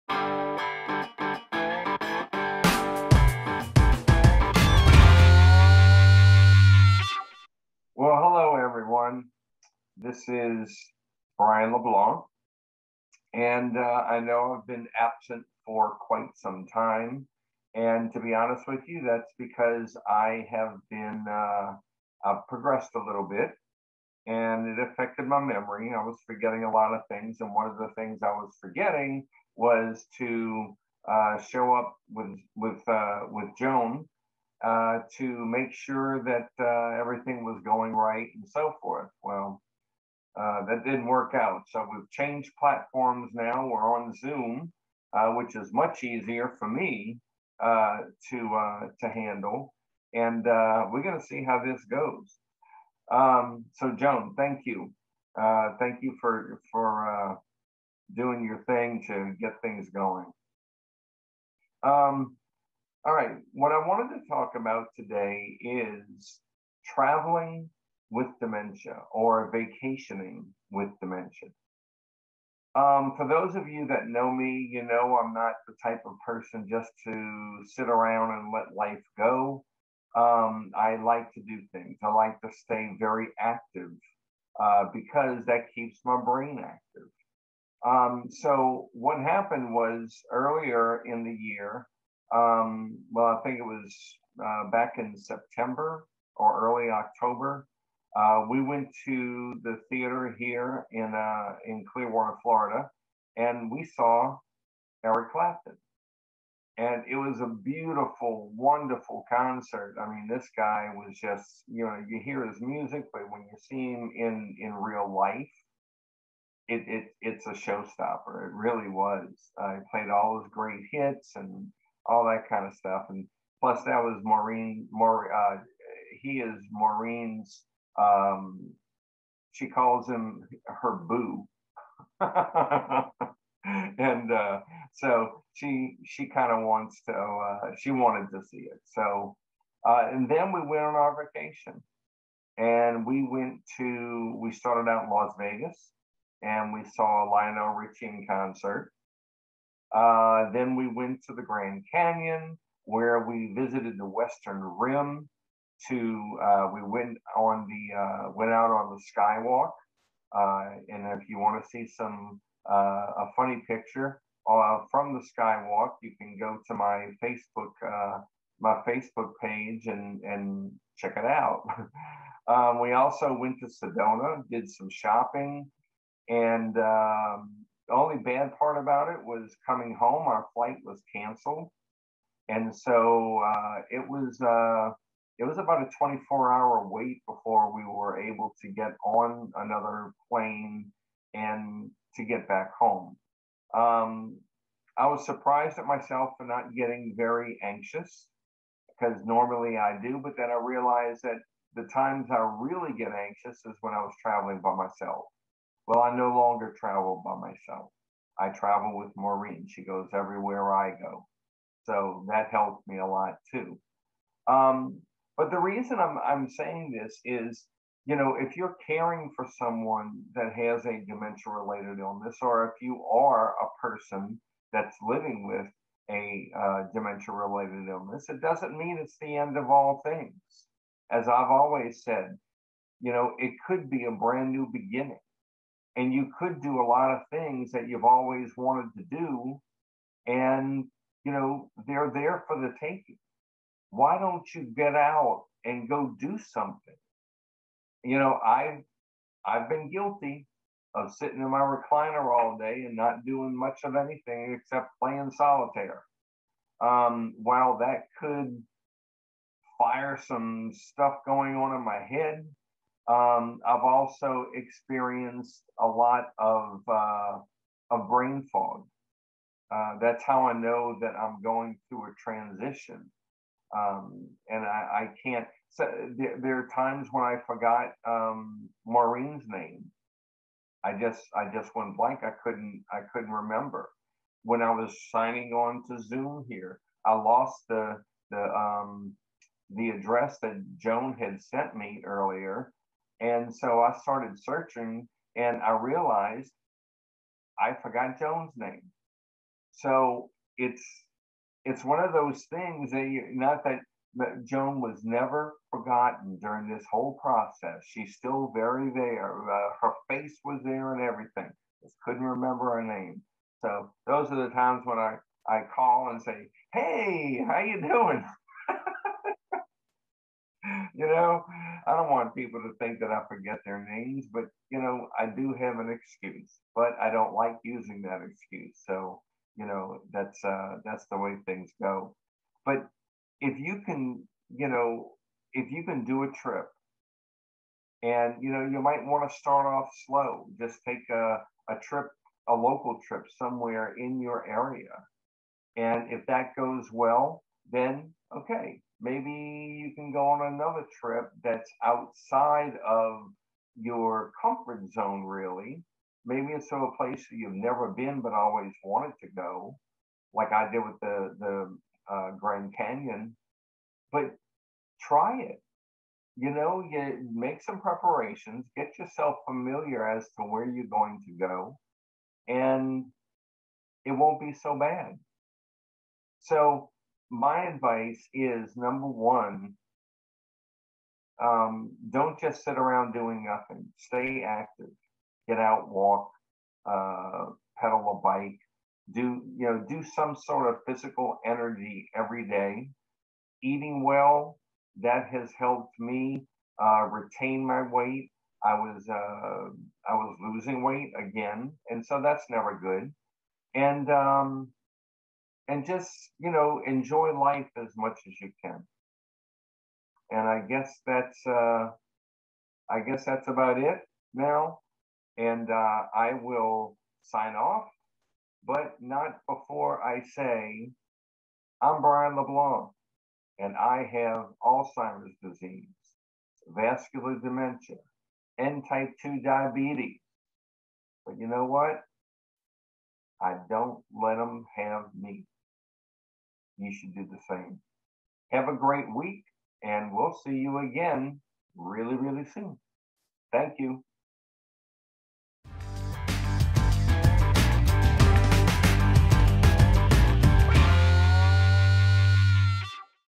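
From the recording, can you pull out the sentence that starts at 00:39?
Well, uh, that didn't work out.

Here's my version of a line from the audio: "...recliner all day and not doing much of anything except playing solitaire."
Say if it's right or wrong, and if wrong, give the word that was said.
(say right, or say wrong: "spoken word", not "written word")
right.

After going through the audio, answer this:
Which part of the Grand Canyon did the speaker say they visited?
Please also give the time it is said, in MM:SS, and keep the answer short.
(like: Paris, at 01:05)
Western rim, at 02:34.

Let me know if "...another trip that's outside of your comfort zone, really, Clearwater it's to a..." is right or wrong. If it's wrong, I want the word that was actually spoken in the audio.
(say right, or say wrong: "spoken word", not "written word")
wrong: "Maybe", not "Clearwater".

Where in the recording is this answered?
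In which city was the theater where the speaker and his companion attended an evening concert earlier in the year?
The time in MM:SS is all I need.
01:41.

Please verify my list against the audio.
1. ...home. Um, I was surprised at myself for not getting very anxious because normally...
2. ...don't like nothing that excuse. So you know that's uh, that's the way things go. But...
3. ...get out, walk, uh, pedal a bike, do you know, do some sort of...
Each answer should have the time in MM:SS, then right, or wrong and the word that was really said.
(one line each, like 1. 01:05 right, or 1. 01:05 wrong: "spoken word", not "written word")
1. 03:12 right
2. 05:27 wrong: "using", not "nothing"
3. 06:25 right.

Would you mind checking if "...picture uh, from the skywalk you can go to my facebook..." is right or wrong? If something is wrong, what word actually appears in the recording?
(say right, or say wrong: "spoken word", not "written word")
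right.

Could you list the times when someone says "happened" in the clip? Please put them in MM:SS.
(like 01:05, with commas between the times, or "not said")
01:29.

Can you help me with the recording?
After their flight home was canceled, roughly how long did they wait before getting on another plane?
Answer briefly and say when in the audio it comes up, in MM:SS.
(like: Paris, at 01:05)
24 hours, at 03:05.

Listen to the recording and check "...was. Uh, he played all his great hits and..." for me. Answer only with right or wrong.
right.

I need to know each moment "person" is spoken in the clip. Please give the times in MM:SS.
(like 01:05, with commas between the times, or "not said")
01:16, 03:43.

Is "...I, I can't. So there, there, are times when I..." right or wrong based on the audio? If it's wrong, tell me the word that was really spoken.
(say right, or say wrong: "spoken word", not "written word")
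right.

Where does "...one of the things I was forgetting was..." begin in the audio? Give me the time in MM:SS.
00:27.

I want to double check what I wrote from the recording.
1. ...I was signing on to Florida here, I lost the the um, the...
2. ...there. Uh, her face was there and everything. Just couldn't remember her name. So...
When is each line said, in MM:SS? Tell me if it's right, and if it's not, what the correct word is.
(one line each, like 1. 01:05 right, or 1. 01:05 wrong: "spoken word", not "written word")
1. 04:44 wrong: "Zoom", not "Florida"
2. 05:08 right.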